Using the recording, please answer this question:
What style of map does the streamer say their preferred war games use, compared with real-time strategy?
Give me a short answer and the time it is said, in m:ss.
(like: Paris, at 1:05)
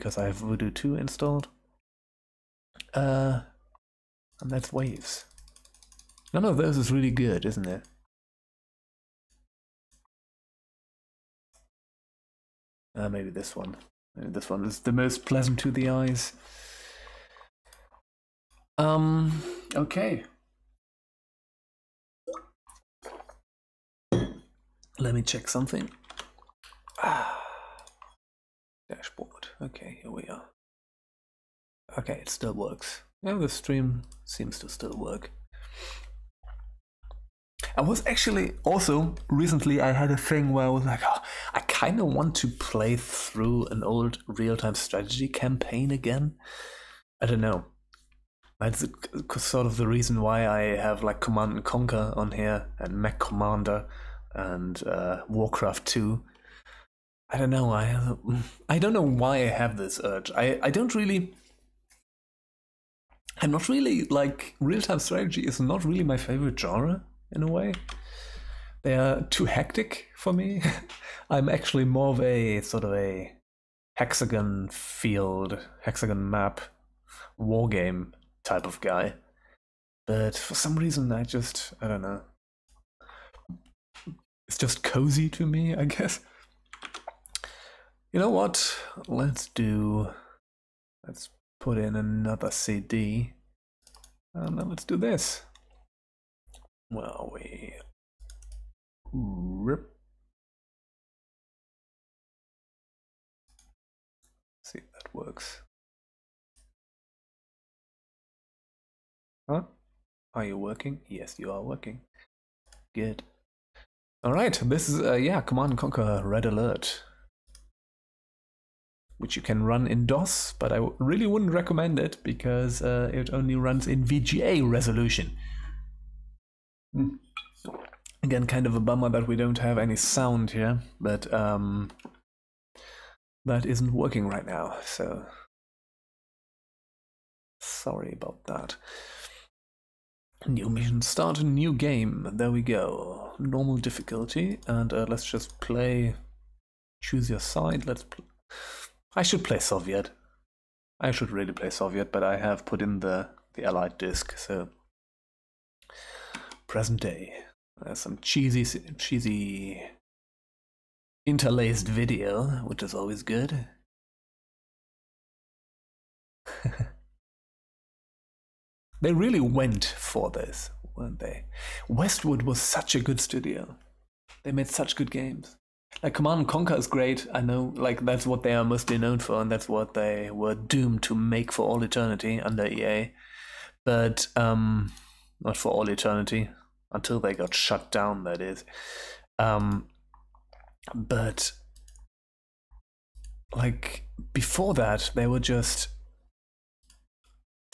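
Hexagon map, at 1:15.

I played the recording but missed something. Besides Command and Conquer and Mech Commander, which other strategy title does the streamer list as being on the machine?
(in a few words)
Warcraft 2.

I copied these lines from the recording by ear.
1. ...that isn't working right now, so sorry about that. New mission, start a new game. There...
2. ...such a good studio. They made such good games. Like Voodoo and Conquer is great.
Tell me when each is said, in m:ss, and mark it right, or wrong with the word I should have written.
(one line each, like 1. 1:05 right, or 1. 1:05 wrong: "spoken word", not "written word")
1. 2:13 right
2. 2:52 wrong: "Command", not "Voodoo".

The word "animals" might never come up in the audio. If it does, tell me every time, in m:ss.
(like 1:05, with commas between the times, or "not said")
not said.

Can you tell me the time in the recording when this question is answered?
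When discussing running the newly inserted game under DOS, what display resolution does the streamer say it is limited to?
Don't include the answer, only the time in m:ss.
2:04.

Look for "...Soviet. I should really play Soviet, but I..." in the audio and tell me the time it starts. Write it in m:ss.
2:29.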